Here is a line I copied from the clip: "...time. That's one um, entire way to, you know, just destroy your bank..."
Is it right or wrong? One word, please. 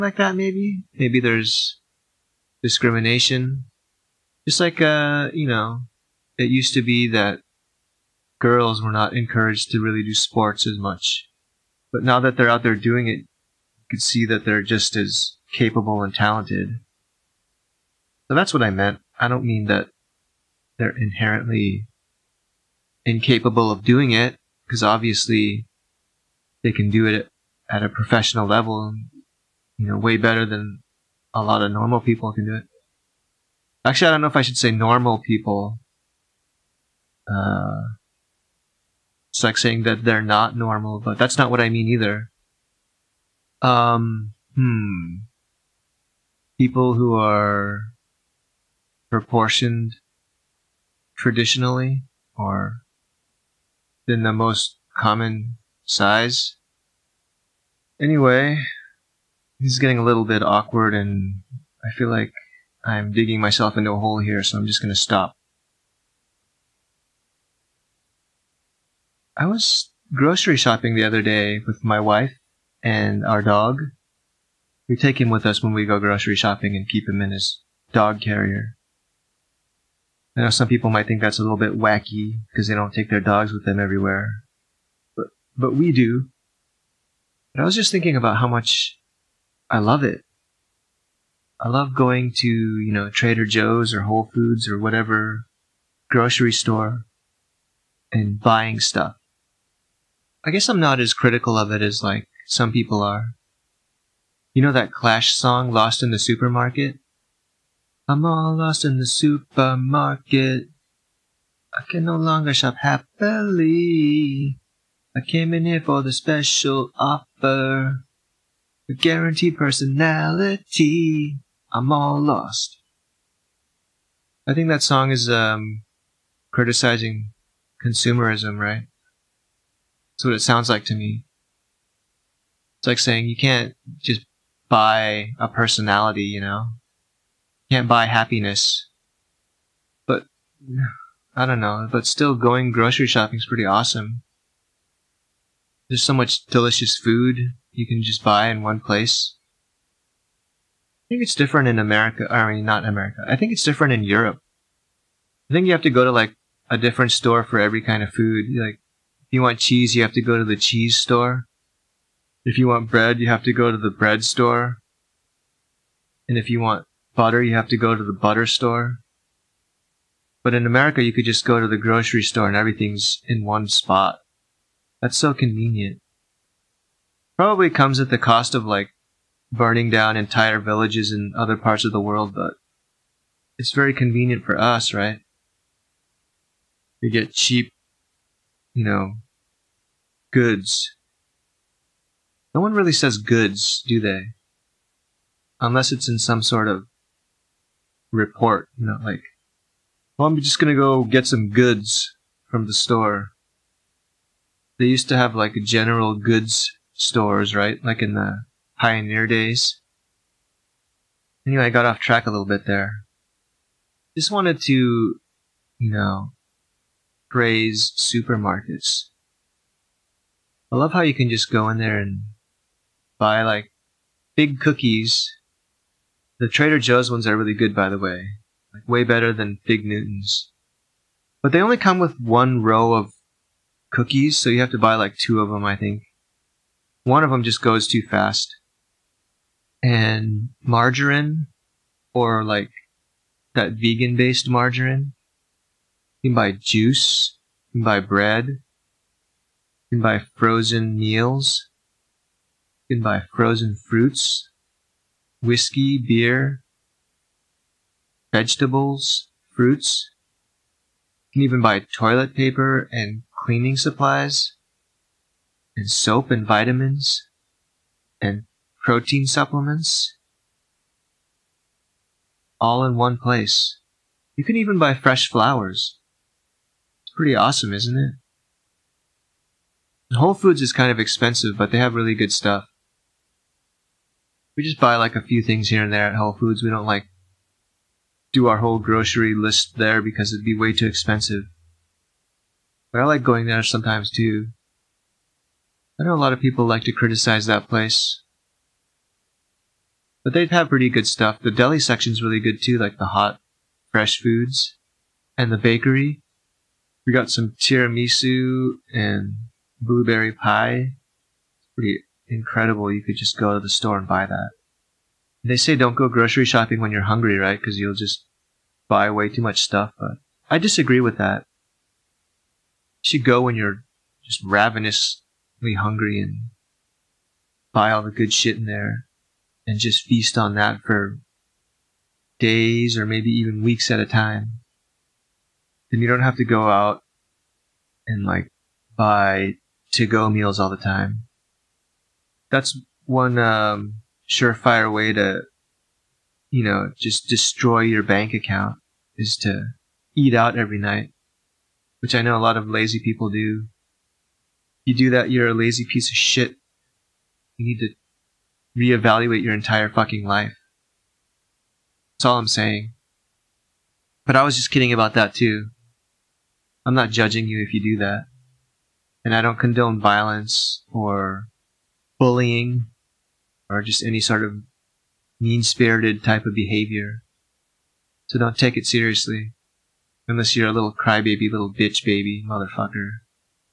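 wrong.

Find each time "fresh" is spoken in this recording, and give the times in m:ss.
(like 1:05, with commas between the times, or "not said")
4:34, 5:03.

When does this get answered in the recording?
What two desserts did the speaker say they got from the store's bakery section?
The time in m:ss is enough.
5:07.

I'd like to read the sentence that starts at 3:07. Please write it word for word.
We get cheap, you know, goods.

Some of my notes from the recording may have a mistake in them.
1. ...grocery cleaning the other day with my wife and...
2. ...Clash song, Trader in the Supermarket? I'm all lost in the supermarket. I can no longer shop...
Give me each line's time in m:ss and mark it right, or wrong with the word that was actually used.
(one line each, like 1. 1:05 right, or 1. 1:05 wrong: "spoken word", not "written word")
1. 1:10 wrong: "shopping", not "cleaning"
2. 1:44 wrong: "Lost", not "Trader".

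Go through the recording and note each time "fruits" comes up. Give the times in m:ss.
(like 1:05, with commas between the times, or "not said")
4:13, 4:19.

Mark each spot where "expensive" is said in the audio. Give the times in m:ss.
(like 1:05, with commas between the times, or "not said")
4:40, 4:50.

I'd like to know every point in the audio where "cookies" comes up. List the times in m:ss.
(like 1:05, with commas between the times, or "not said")
3:44, 3:53.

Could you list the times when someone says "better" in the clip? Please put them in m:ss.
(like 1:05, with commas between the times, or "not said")
0:30, 3:49.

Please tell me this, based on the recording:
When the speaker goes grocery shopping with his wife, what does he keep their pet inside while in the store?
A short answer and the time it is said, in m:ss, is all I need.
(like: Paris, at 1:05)
dog carrier, at 1:17.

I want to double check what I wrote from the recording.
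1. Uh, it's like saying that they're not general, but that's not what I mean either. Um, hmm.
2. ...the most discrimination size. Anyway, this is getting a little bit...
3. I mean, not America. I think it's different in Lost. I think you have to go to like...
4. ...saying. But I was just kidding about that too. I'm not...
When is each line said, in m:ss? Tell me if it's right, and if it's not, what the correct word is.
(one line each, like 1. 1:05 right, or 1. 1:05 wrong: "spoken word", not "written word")
1. 0:37 wrong: "normal", not "general"
2. 0:54 wrong: "common", not "discrimination"
3. 2:32 wrong: "Europe", not "Lost"
4. 6:02 right.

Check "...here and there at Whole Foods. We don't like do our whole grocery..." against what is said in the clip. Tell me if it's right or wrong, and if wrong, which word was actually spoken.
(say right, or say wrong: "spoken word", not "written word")
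right.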